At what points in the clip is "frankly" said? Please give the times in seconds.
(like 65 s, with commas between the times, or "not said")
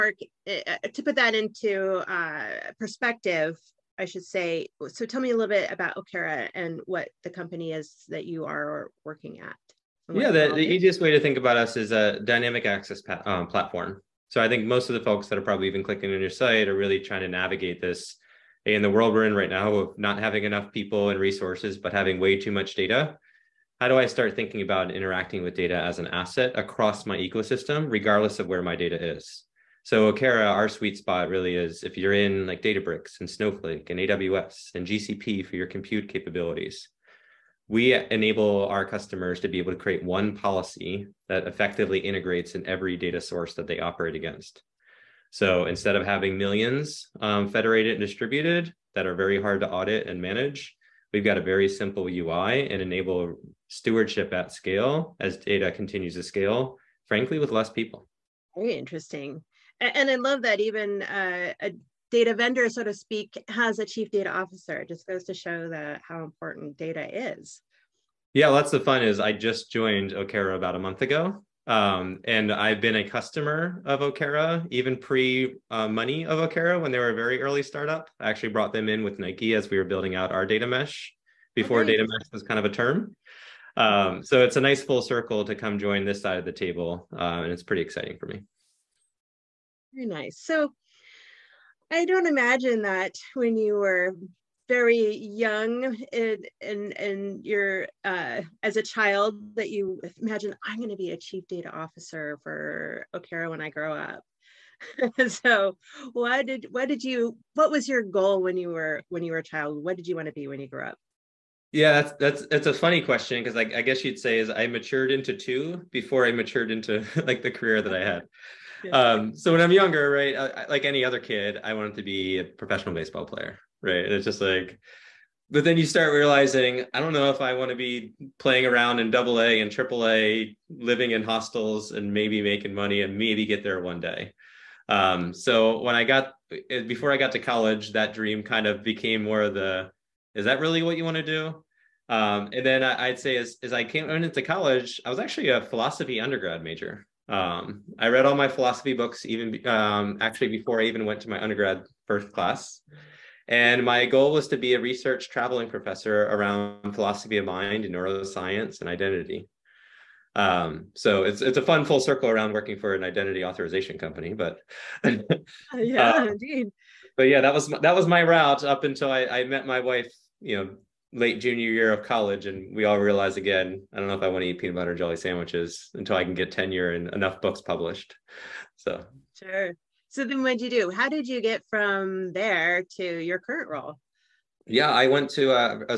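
57 s.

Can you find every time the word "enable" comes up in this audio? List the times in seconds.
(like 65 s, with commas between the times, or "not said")
37 s, 52 s.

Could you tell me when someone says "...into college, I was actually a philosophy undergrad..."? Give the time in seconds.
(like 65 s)
144 s.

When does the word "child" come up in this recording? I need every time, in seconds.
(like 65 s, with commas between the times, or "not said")
98 s, 109 s.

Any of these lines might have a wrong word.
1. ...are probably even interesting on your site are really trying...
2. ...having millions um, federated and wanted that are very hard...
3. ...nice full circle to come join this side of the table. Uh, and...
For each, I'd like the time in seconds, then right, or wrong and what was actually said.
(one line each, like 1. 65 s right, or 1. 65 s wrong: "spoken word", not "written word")
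1. 15 s wrong: "clicking", not "interesting"
2. 46 s wrong: "distributed", not "wanted"
3. 84 s right.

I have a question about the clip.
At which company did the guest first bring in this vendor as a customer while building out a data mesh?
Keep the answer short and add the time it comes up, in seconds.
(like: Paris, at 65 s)
Nike, at 79 s.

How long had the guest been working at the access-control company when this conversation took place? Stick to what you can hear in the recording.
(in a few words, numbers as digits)
About a month.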